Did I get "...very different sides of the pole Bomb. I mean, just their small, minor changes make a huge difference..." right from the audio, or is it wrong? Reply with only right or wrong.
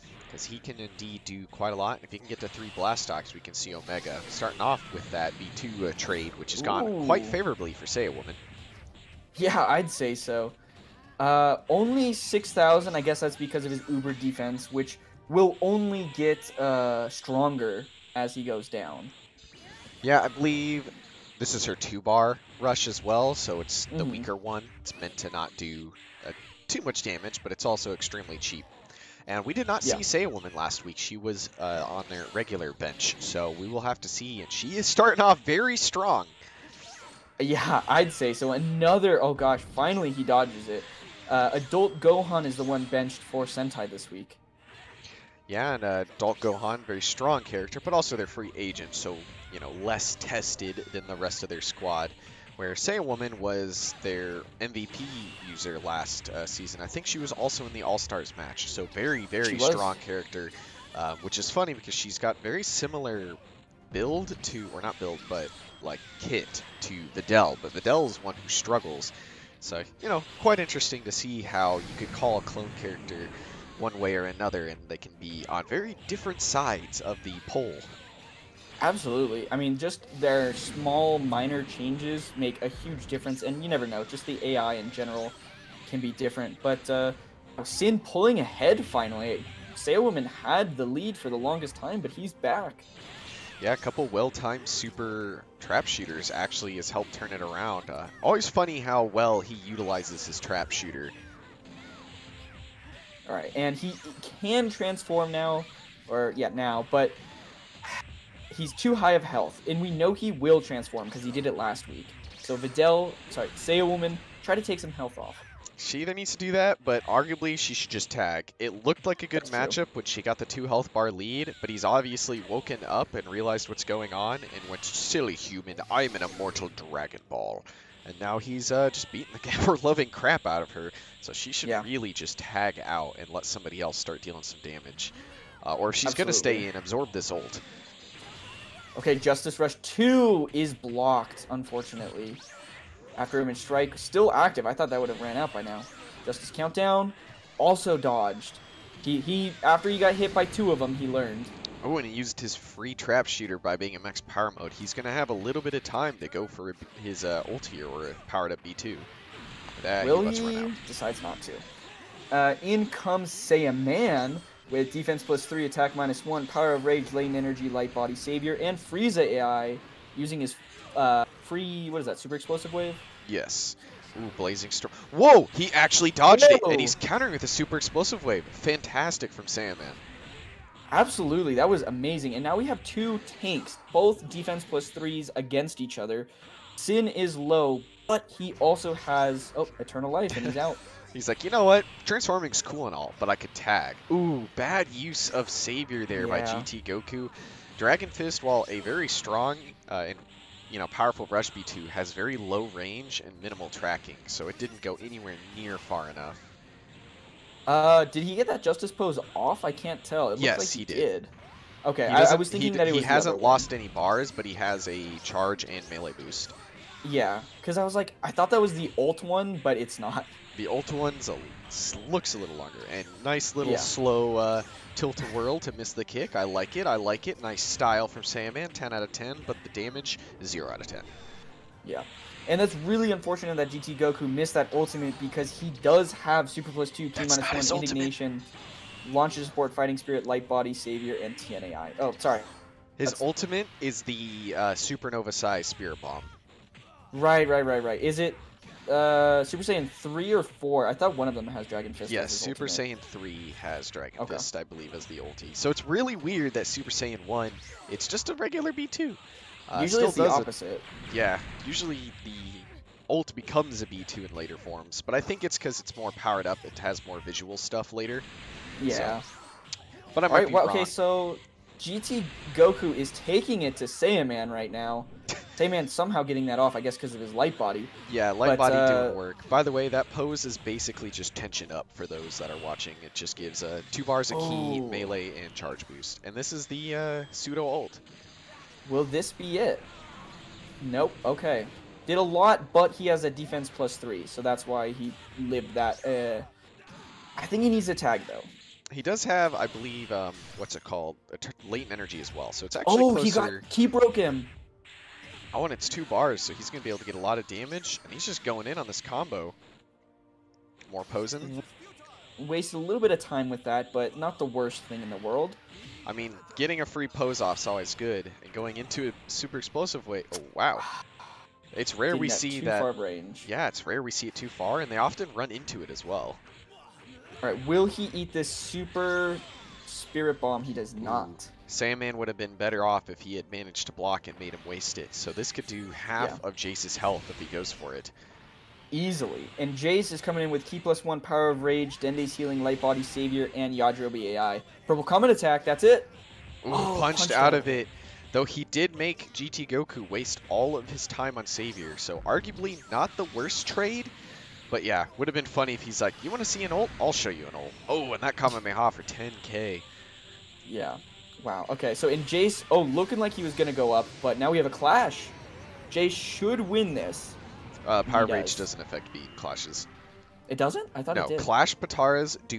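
wrong.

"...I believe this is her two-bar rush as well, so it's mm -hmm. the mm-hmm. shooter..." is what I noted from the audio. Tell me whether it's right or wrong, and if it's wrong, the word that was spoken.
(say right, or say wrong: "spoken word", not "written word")
wrong: "weaker", not "shooter".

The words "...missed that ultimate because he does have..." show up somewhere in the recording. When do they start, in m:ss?
3:54.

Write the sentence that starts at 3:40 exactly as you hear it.
The Ulta one's looks a little longer.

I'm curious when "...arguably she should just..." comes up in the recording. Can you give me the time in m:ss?
1:57.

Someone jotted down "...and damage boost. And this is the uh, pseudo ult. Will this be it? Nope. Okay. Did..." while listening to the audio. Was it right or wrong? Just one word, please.
wrong.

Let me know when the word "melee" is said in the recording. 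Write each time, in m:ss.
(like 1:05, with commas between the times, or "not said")
3:35, 4:44.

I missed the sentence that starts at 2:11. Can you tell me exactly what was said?
really just tag out and let somebody else start dealing some damage.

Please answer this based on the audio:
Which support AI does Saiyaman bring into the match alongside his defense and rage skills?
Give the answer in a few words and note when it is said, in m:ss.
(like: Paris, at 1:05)
Frieza AI, at 2:48.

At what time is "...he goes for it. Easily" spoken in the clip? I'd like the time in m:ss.
5:37.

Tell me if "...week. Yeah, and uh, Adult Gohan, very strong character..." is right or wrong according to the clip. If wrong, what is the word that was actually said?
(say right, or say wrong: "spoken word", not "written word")
right.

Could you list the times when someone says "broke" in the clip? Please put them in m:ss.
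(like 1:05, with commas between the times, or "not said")
5:03.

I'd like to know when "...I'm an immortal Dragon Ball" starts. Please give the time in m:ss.
2:05.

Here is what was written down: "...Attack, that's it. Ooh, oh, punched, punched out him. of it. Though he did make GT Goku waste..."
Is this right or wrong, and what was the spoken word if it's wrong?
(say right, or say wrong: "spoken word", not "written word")
right.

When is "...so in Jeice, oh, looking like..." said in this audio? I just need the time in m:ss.
6:01.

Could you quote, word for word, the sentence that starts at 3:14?
Ooh, bad use of Savior there yeah.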